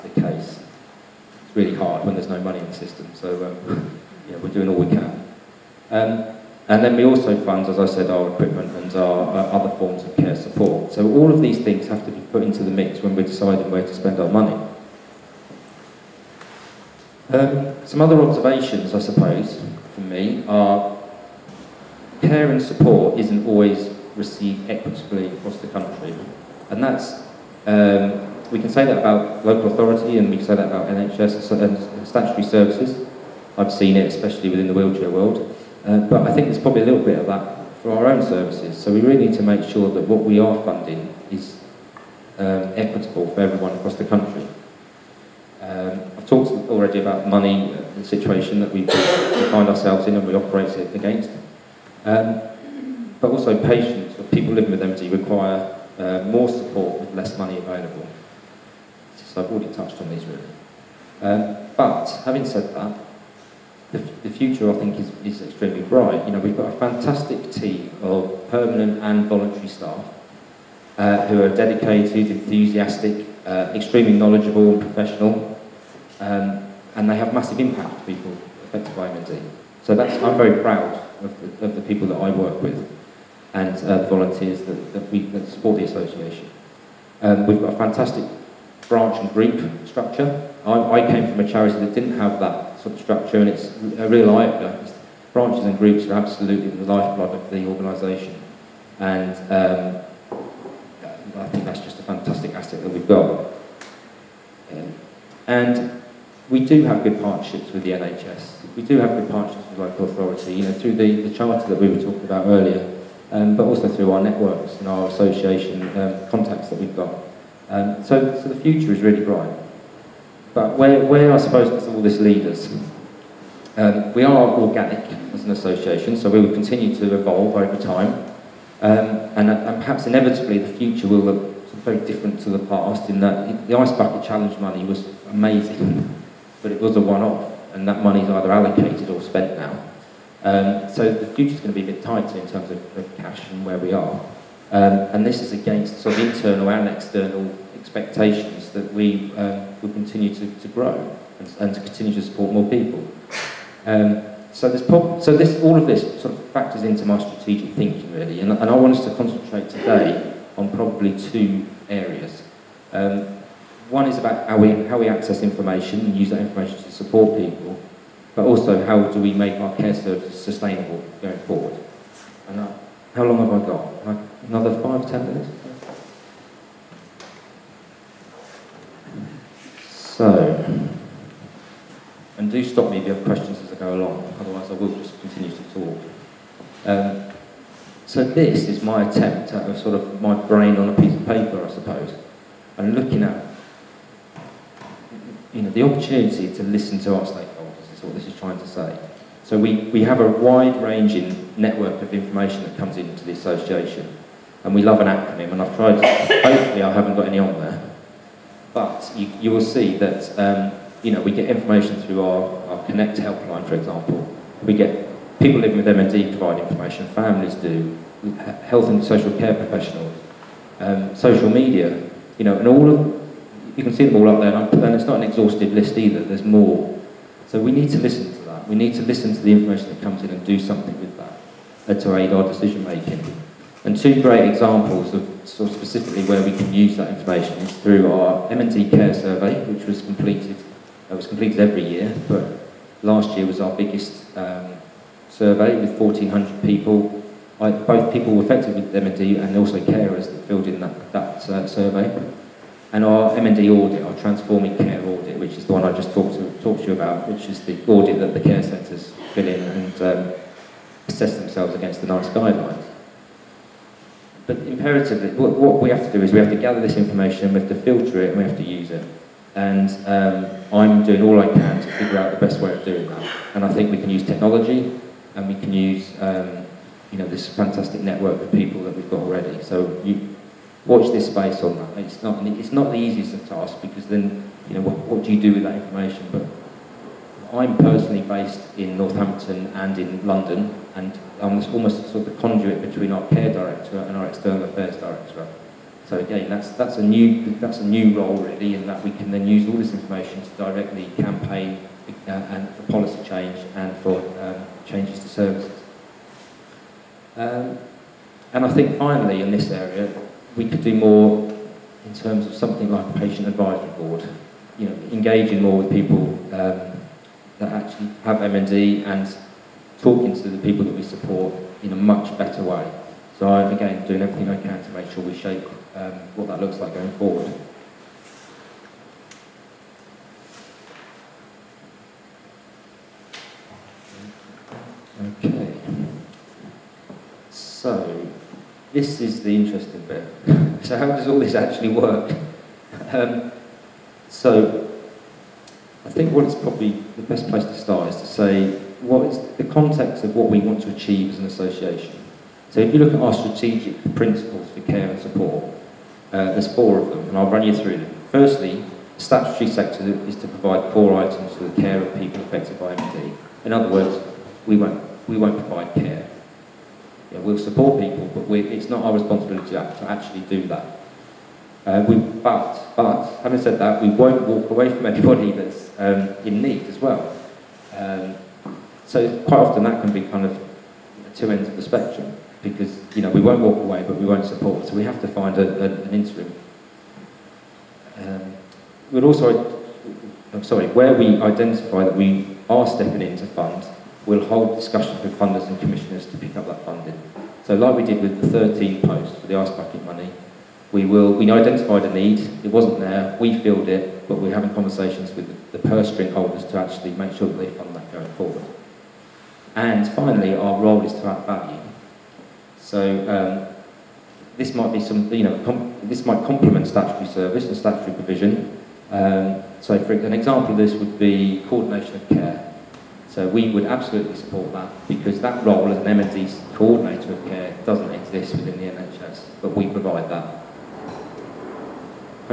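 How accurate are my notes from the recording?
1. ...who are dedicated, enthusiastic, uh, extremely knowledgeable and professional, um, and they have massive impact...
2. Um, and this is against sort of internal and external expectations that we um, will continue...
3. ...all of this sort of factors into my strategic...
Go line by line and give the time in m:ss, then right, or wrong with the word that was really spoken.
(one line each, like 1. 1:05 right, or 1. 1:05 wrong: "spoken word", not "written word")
1. 1:11 right
2. 2:24 right
3. 2:35 right.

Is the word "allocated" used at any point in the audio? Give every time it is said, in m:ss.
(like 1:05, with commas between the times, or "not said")
2:18.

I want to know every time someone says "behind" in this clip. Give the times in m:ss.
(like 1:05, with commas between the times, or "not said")
not said.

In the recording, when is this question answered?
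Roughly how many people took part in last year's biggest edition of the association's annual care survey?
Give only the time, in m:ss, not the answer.
4:05.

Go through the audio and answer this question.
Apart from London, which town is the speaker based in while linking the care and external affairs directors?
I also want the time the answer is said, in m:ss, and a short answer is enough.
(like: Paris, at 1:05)
Northampton, at 4:48.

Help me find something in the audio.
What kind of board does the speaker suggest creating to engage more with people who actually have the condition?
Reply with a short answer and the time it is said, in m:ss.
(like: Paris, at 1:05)
patient advisory board, at 5:13.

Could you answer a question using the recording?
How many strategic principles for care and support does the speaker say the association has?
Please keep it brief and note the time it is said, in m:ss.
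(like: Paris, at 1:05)
4, at 5:56.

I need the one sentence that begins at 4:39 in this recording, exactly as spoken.
So you, watch this space on that.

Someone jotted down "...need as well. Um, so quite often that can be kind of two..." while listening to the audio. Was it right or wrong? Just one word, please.
right.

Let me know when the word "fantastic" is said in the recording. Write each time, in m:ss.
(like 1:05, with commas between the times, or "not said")
1:06, 1:27, 1:42, 4:37.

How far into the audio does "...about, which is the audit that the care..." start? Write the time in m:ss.
4:16.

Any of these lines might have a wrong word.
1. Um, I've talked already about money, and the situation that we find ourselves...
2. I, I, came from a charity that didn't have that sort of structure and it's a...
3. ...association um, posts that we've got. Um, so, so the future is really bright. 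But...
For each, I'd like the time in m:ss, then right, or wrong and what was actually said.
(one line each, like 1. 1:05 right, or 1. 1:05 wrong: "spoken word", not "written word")
1. 0:45 right
2. 1:30 right
3. 1:55 wrong: "contacts", not "posts".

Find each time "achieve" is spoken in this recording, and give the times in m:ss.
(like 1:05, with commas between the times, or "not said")
5:50.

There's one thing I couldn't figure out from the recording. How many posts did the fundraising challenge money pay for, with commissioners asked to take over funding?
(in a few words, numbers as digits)
13.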